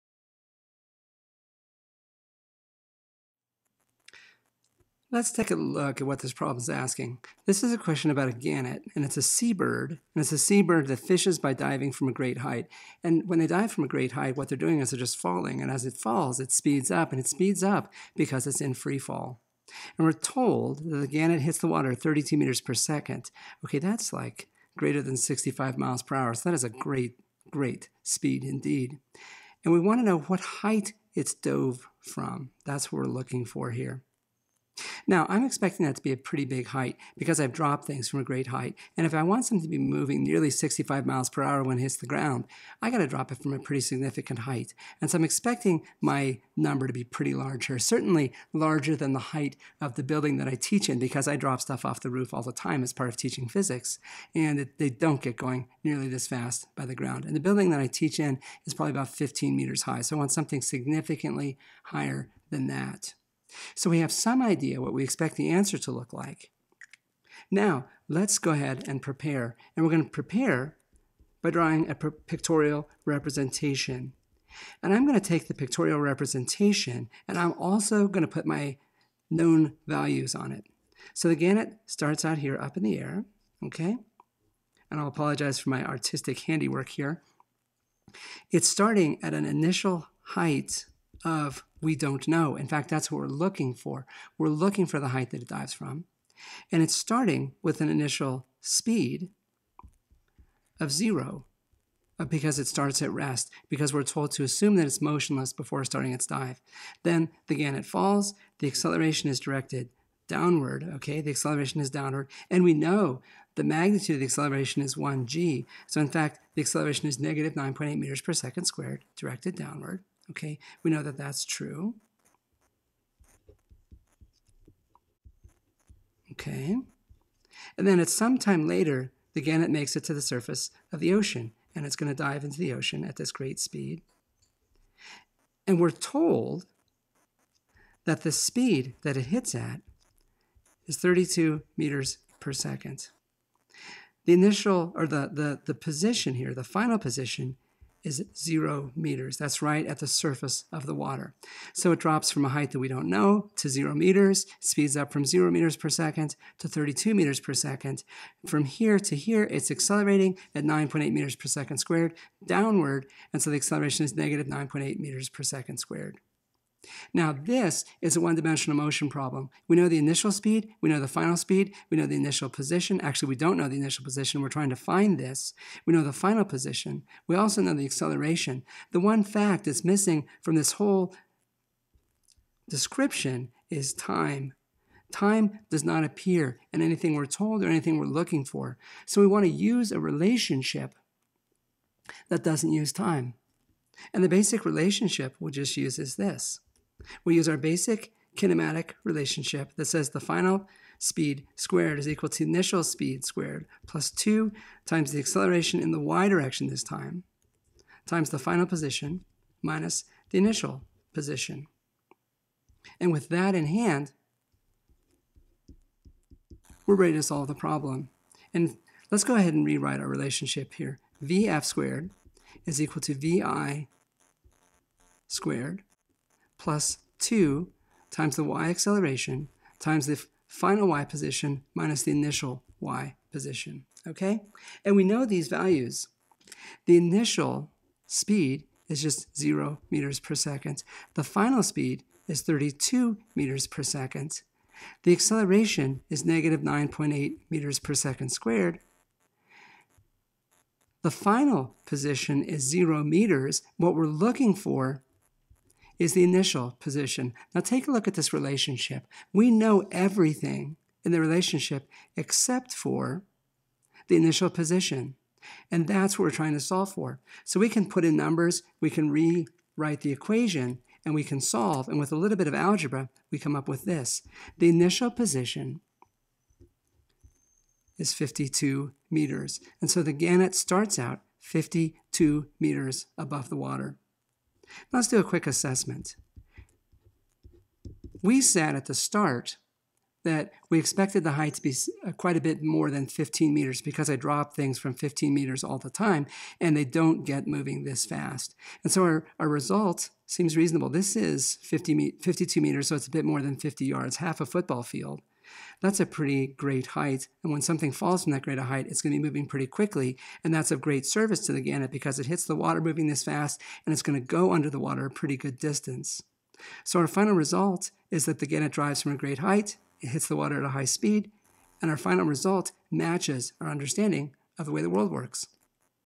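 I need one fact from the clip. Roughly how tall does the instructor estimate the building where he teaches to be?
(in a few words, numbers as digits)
about 15 meters.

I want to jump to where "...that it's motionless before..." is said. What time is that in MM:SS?
01:44.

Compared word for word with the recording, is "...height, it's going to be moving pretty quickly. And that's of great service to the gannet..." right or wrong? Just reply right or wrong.
right.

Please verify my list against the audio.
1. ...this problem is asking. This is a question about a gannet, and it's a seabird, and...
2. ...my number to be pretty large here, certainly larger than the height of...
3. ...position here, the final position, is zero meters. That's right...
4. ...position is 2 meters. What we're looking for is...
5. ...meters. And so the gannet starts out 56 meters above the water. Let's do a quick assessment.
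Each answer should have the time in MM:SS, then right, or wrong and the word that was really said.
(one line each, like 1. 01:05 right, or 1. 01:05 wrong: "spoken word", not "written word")
1. 00:06 right
2. 00:46 right
3. 02:25 right
4. 04:11 wrong: "0", not "2"
5. 04:39 wrong: "52", not "56".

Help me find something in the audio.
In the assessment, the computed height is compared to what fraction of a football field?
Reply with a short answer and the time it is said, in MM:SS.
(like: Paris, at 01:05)
half, at 05:04.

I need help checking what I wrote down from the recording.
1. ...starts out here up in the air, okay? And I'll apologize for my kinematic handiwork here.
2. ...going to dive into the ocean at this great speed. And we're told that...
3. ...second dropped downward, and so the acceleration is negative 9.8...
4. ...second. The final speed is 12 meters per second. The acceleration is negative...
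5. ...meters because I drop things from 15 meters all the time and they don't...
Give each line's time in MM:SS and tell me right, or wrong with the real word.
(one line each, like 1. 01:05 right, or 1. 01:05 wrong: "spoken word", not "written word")
1. 01:21 wrong: "artistic", not "kinematic"
2. 02:11 right
3. 02:41 wrong: "squared", not "dropped"
4. 04:00 wrong: "32", not "12"
5. 04:53 right.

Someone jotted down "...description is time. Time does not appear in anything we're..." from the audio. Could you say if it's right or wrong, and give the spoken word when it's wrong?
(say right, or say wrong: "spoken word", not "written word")
right.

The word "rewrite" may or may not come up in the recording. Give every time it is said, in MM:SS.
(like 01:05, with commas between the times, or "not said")
03:39, 04:29.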